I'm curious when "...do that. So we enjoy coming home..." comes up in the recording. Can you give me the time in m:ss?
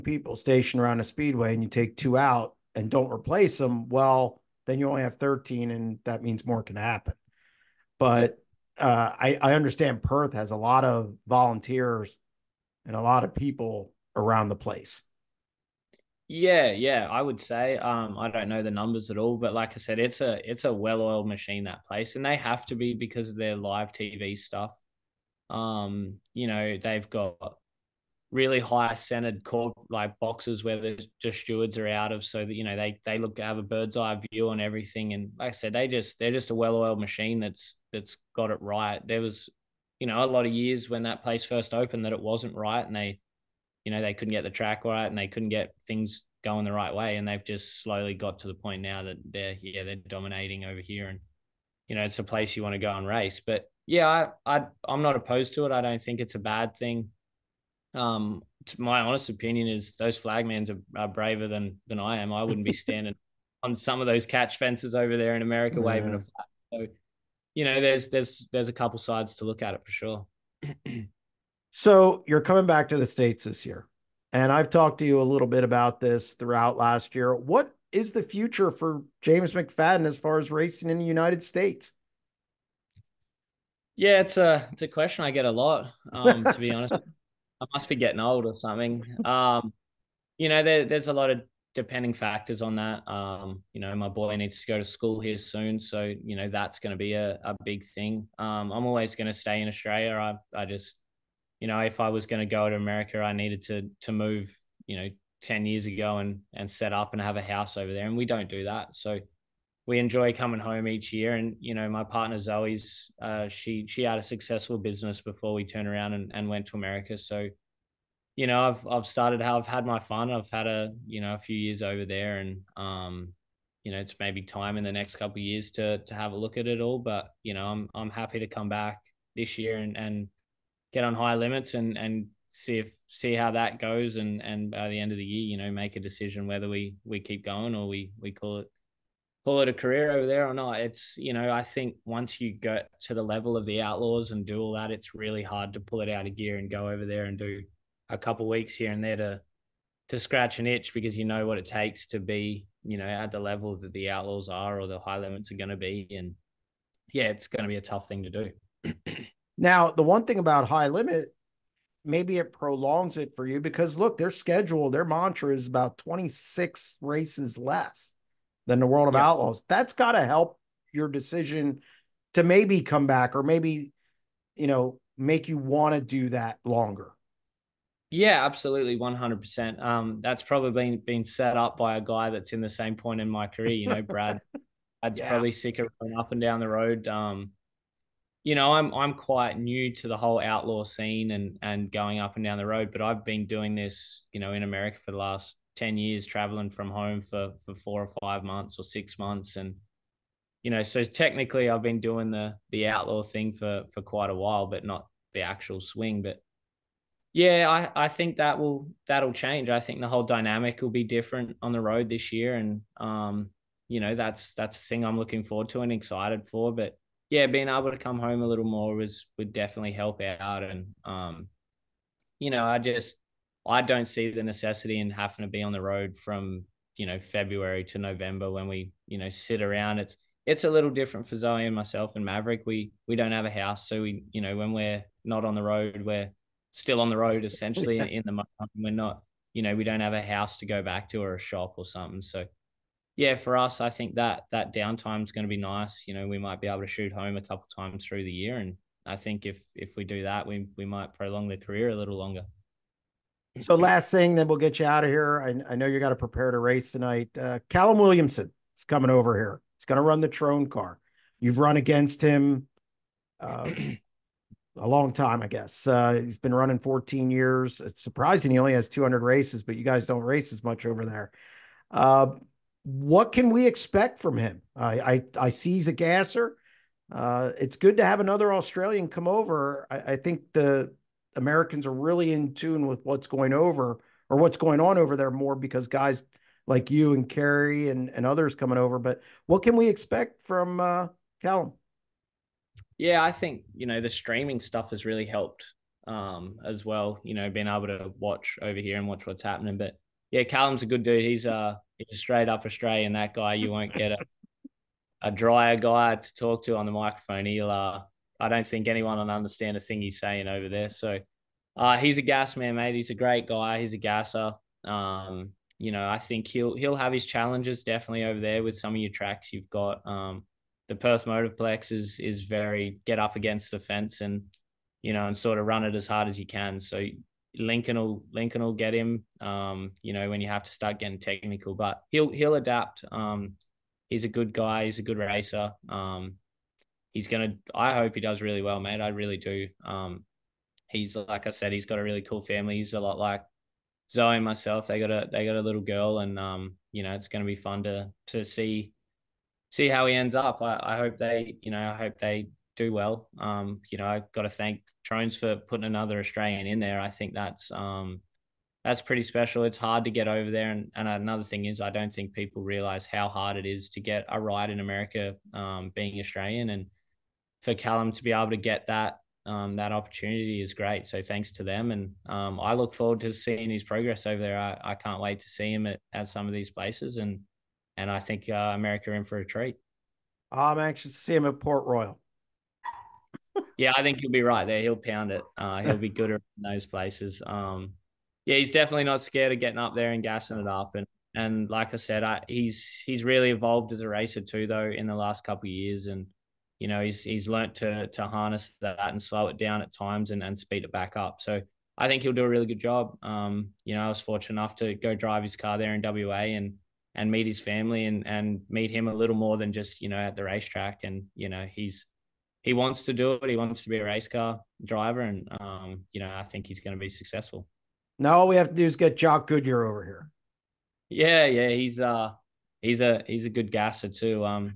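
1:48.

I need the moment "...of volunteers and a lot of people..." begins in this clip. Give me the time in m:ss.
0:10.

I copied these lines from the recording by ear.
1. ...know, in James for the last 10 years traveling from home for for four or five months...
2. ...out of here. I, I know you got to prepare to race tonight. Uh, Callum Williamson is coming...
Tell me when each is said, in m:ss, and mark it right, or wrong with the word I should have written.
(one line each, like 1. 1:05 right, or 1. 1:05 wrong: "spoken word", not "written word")
1. 3:14 wrong: "America", not "James"
2. 4:14 right.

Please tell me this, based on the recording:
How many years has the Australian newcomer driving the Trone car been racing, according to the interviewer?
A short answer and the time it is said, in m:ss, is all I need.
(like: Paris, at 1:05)
14, at 4:26.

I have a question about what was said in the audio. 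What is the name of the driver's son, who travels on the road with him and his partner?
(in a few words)
Maverick.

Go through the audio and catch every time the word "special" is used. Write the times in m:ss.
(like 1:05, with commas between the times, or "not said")
5:59.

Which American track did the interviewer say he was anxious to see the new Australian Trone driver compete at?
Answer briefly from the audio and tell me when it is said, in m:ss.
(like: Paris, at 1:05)
Port Royal, at 6:21.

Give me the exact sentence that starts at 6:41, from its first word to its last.
So I think he'll do a really good job.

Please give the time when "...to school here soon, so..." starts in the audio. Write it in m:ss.
1:34.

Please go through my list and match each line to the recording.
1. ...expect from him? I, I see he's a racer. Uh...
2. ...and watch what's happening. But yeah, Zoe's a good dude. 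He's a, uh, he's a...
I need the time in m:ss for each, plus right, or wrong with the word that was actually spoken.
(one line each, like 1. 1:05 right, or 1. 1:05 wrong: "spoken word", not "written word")
1. 4:33 wrong: "gasser", not "racer"
2. 4:58 wrong: "Callum", not "Zoe".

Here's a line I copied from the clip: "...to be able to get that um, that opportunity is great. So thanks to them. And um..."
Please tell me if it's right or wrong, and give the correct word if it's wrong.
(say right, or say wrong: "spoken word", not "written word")
right.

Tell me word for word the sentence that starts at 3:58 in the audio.
We're not you know we don't have a house to go back to or a shop or something.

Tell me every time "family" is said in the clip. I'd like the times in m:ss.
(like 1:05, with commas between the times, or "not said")
5:42, 6:47.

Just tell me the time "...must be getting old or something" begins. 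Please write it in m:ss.
1:27.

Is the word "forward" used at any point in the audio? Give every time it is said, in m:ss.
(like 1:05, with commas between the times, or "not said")
3:35, 6:12.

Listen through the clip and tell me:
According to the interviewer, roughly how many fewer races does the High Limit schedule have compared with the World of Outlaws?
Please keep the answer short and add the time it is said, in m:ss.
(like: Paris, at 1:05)
26, at 2:45.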